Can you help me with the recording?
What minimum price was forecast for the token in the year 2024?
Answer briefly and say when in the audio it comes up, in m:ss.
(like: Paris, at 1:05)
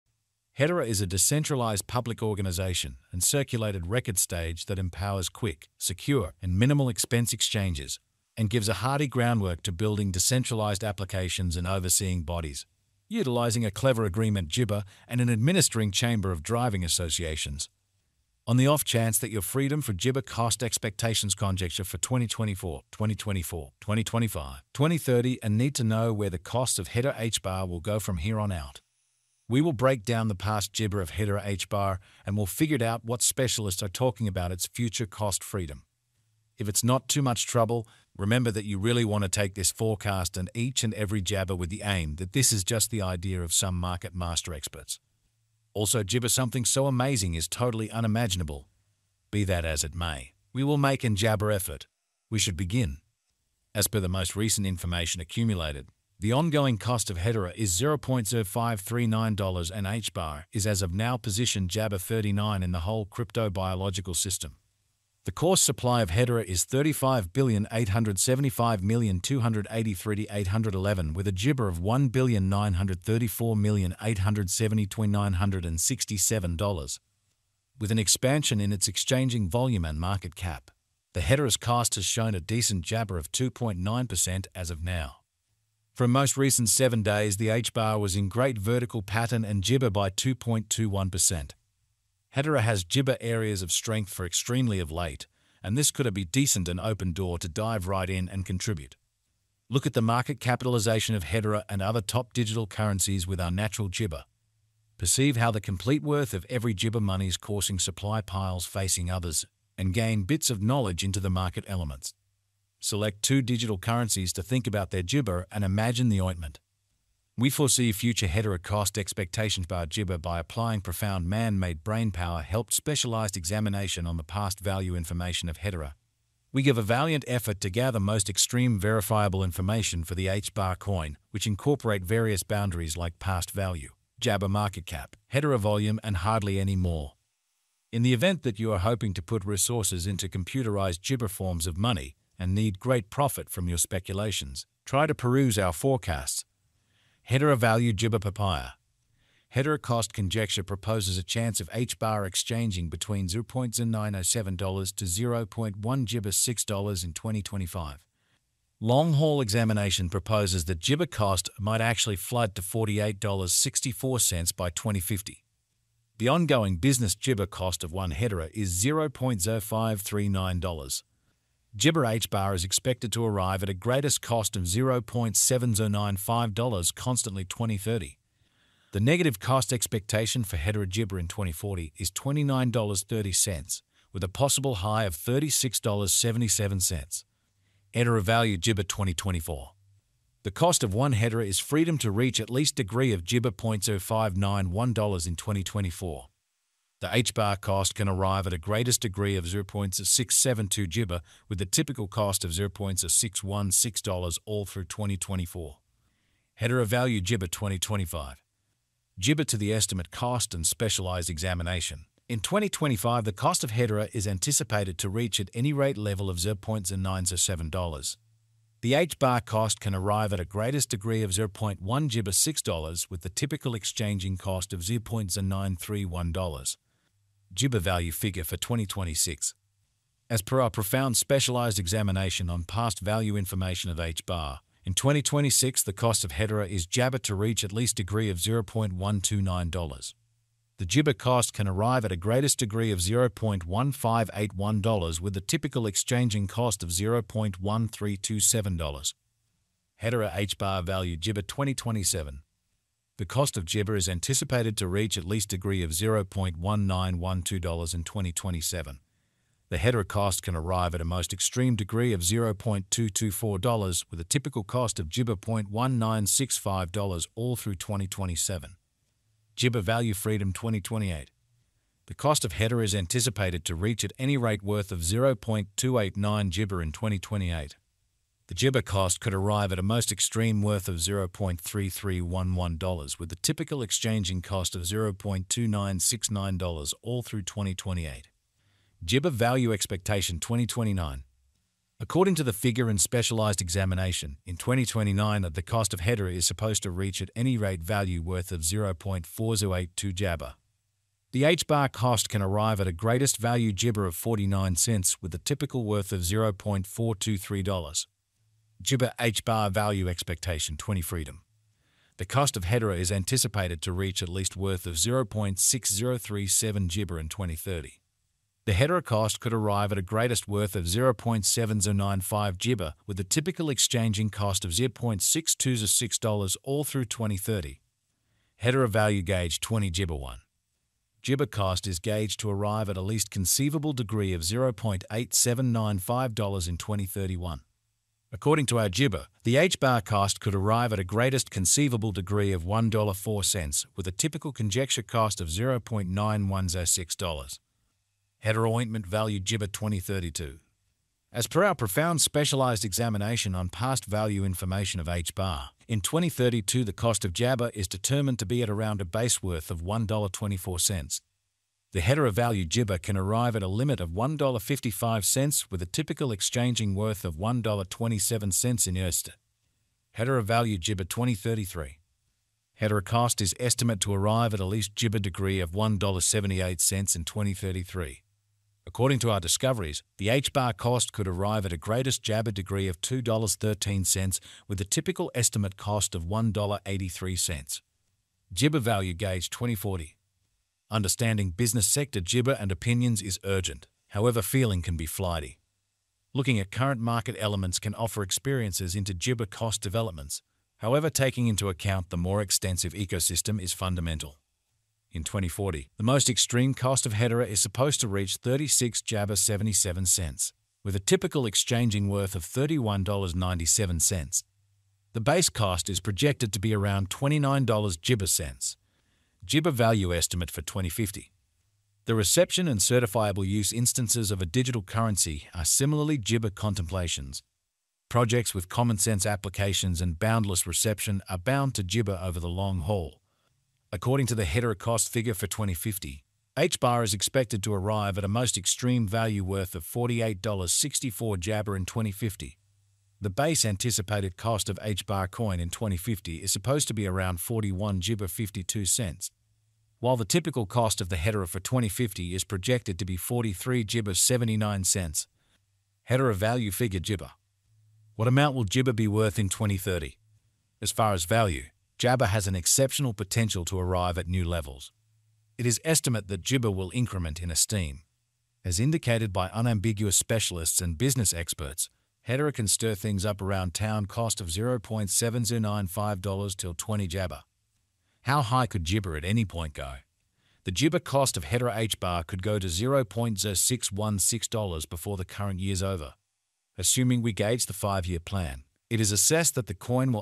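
$0.0591, at 3:13.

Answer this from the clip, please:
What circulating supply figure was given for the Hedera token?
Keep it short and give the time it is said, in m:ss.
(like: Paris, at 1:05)
35,875,283,811, at 1:06.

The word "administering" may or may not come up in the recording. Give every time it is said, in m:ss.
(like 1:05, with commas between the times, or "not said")
0:15.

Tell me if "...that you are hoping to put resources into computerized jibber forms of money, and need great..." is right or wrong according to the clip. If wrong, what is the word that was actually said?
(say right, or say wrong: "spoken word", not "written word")
right.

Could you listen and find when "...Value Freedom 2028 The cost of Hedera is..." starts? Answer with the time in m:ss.
4:29.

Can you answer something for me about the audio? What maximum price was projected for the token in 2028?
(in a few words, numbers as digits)
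$0.3311.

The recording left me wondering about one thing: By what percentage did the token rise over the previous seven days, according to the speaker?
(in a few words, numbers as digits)
2.21%.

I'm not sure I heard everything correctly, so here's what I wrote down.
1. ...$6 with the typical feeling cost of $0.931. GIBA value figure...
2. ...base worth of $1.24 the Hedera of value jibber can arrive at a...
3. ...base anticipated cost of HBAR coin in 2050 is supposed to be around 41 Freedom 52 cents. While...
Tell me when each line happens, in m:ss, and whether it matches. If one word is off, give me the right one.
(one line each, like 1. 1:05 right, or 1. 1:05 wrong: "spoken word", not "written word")
1. 3:42 wrong: "exchanging", not "feeling"
2. 5:59 right
3. 7:23 wrong: "Jibber", not "Freedom".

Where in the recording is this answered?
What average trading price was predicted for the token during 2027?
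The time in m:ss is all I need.
4:25.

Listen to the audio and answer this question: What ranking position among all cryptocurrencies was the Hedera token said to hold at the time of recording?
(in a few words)
39.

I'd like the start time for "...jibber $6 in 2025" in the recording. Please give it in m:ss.
2:36.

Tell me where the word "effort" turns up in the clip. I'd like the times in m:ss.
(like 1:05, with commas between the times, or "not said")
0:51, 2:07.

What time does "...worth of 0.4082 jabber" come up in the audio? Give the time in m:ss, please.
4:58.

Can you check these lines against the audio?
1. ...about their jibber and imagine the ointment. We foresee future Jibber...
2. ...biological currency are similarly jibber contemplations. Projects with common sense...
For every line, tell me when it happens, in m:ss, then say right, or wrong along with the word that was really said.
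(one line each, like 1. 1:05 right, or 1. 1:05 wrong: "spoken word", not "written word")
1. 1:54 wrong: "Hedera", not "Jibber"
2. 7:04 wrong: "digital", not "biological".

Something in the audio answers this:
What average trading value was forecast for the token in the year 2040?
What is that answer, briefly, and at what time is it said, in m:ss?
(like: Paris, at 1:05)
$31.97, at 6:52.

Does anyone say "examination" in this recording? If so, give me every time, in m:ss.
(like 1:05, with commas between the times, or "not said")
2:03, 2:39, 3:31, 3:51, 4:53, 5:52.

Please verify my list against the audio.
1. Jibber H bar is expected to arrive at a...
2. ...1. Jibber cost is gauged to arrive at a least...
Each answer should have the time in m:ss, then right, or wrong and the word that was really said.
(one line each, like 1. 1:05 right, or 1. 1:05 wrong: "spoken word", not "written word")
1. 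2:51 right
2. 5:30 right.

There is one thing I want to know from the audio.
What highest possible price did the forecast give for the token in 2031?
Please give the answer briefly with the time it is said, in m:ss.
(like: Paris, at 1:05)
$1.04, at 5:42.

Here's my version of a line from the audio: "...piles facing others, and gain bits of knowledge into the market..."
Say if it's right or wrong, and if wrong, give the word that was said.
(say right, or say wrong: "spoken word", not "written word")
right.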